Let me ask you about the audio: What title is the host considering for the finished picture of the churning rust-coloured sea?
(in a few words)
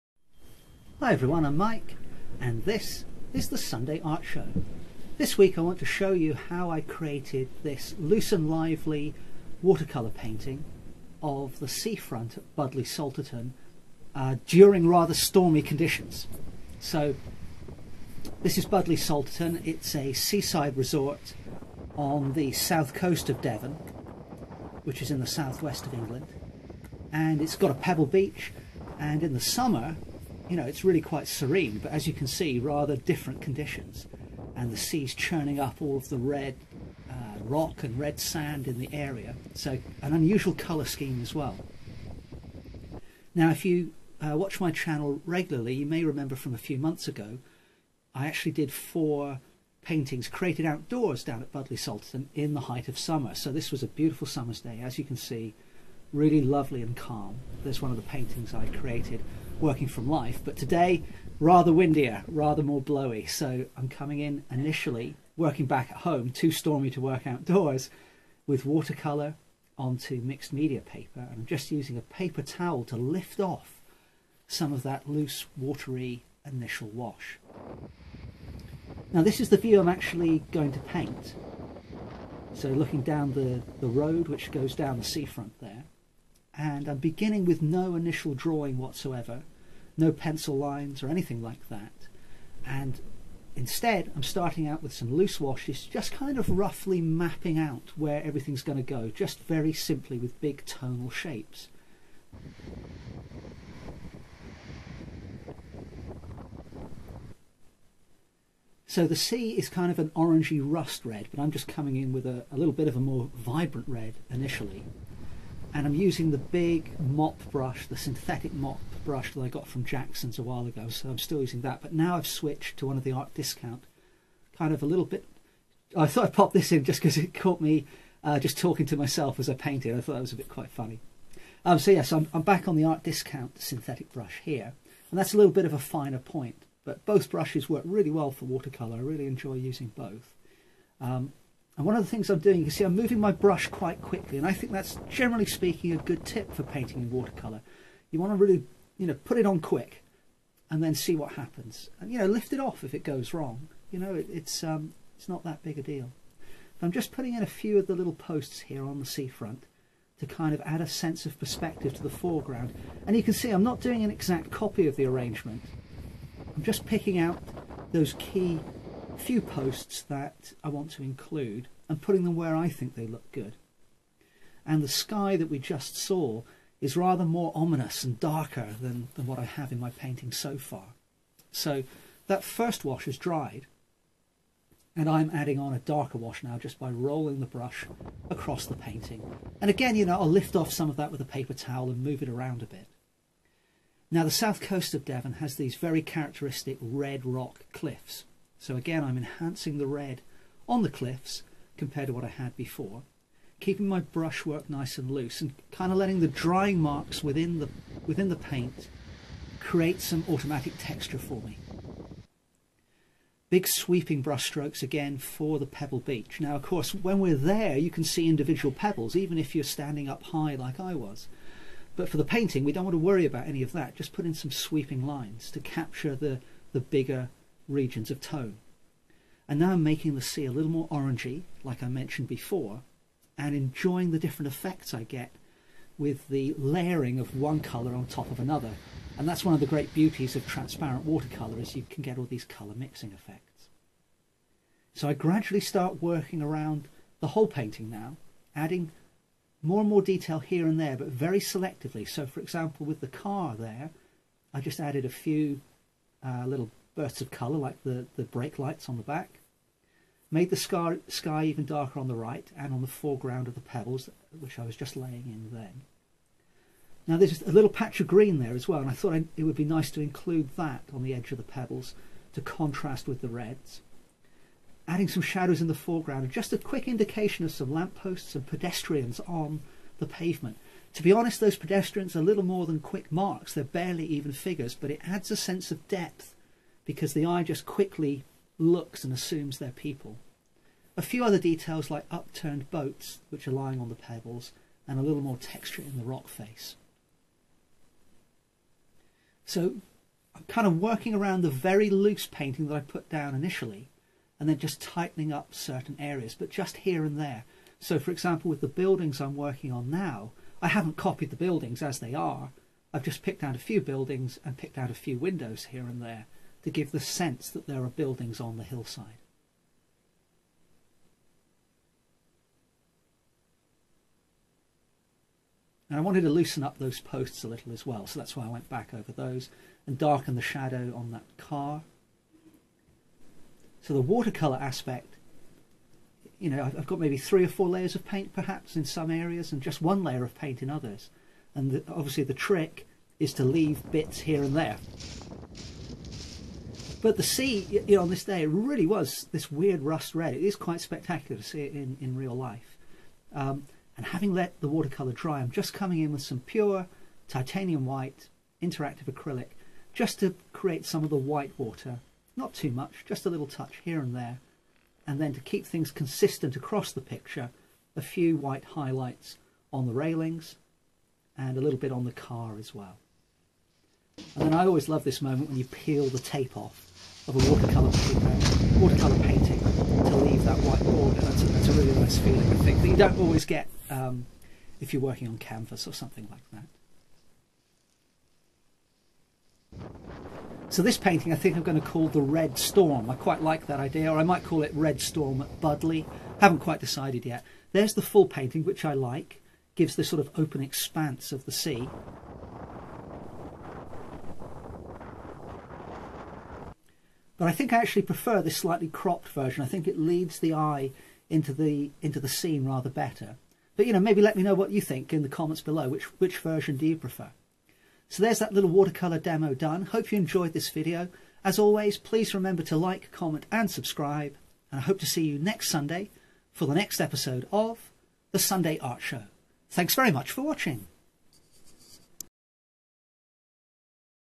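The Red Storm.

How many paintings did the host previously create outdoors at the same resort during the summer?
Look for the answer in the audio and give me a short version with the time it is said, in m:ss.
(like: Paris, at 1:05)
4, at 0:48.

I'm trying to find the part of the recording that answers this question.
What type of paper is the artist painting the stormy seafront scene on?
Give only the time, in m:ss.
1:10.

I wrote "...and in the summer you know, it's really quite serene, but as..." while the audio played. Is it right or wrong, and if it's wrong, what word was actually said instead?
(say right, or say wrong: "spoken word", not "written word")
right.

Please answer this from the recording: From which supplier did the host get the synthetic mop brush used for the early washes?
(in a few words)
Jackson's.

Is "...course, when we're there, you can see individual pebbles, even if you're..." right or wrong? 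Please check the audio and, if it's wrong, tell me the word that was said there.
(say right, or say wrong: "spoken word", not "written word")
right.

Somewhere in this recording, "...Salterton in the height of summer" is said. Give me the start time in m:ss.
0:51.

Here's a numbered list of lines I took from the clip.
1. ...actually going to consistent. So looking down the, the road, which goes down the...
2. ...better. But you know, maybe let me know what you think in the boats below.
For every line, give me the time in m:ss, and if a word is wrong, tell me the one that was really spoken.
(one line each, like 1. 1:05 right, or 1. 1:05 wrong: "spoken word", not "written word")
1. 1:19 wrong: "paint", not "consistent"
2. 6:52 wrong: "comments", not "boats".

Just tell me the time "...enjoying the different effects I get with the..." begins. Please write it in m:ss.
3:53.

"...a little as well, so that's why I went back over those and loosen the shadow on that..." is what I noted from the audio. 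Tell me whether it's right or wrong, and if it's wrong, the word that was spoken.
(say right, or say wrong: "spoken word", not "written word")
wrong: "darken", not "loosen".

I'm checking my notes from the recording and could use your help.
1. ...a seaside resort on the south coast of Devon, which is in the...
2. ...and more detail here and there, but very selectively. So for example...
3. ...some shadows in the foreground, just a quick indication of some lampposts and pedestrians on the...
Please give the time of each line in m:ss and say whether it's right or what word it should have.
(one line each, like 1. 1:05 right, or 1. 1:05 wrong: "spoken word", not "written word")
1. 0:19 right
2. 4:09 right
3. 4:35 right.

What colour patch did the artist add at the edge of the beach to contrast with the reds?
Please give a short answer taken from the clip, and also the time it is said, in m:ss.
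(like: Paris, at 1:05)
green, at 4:28.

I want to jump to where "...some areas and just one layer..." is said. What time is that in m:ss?
5:38.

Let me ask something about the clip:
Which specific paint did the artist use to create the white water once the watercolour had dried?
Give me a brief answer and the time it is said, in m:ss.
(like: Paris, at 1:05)
titanium white interactive acrylic, at 5:57.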